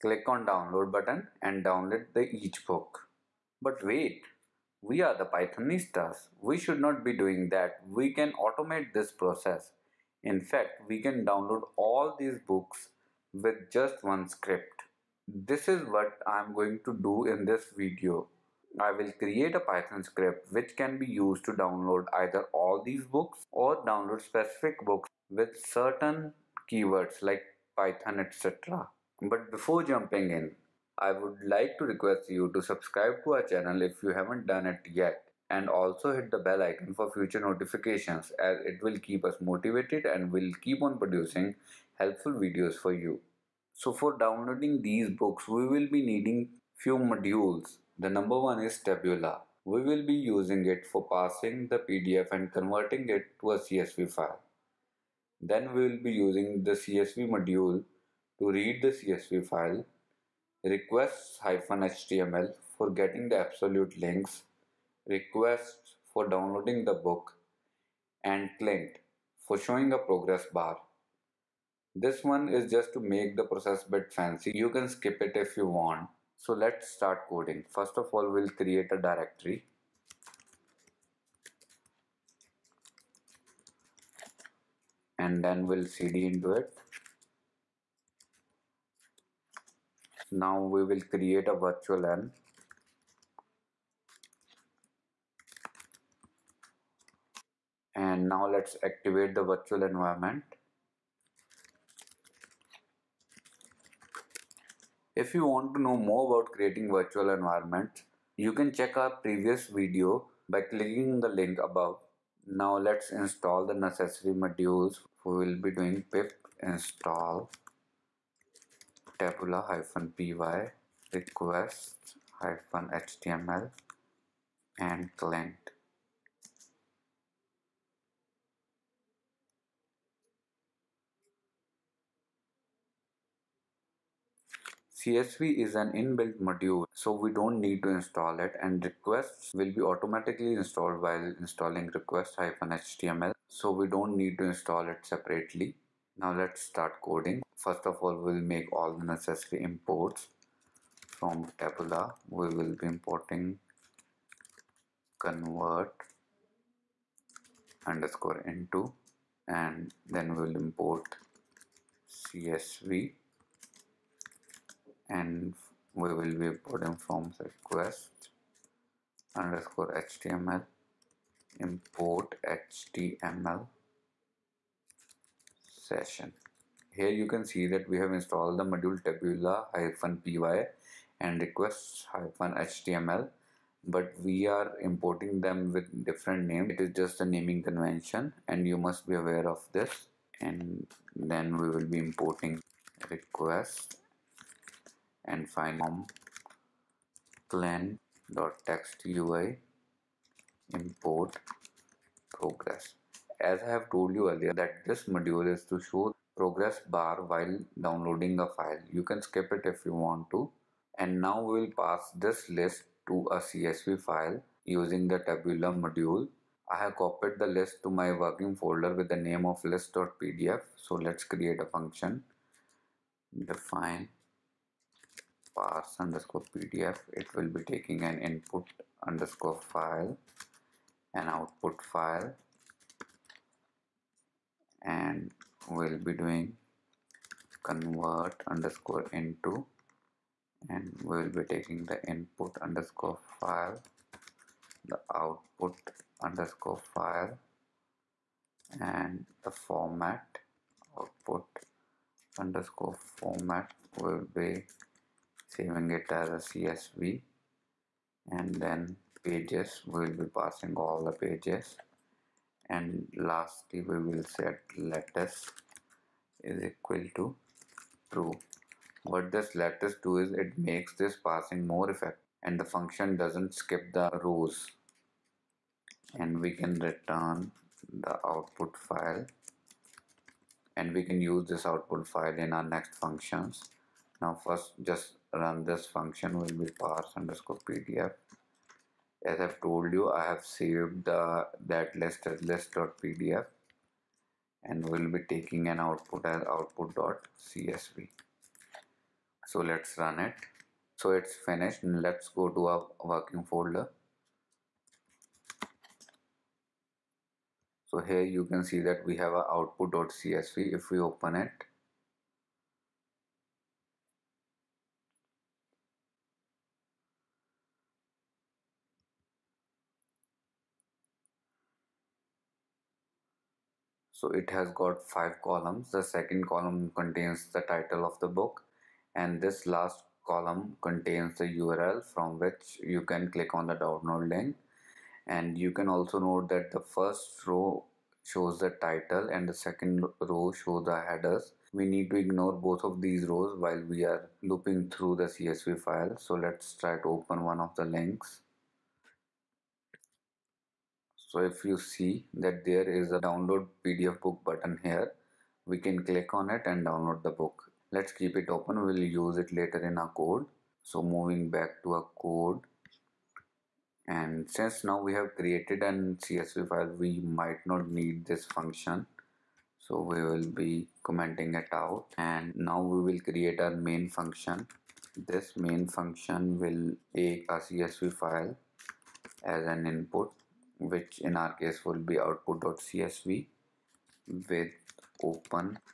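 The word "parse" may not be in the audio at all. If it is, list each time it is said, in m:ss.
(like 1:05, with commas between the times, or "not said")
3:45, 4:46.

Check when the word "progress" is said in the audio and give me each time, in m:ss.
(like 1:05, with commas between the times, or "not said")
1:09, 3:22, 3:26.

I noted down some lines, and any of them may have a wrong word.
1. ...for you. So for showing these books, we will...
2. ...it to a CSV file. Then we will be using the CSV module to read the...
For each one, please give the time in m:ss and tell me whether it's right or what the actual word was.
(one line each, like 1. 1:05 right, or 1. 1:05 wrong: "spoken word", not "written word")
1. 0:42 wrong: "downloading", not "showing"
2. 0:53 right.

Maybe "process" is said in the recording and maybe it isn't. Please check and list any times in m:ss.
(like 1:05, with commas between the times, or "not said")
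0:09, 1:13.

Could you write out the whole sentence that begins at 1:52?
Now let's install the necessary modules.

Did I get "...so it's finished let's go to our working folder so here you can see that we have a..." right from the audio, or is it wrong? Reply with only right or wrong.
right.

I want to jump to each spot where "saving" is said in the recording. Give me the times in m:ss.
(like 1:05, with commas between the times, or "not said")
4:15.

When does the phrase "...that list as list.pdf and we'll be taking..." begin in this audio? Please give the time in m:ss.
4:51.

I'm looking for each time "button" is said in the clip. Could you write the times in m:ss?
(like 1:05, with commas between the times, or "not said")
0:00, 5:54.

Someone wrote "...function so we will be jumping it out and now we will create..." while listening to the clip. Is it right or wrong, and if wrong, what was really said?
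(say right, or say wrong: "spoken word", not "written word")
wrong: "commenting", not "jumping".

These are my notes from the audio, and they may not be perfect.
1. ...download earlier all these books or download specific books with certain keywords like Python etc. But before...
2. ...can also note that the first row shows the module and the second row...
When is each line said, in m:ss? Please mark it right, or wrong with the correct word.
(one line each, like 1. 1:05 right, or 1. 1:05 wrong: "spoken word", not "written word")
1. 0:21 wrong: "either", not "earlier"
2. 5:35 wrong: "title", not "module".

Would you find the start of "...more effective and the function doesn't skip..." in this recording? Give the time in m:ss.
4:31.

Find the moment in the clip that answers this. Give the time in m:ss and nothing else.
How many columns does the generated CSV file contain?
5:25.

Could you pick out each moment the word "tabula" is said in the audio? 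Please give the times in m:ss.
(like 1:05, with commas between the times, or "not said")
0:48, 1:59, 2:31, 2:59, 3:35.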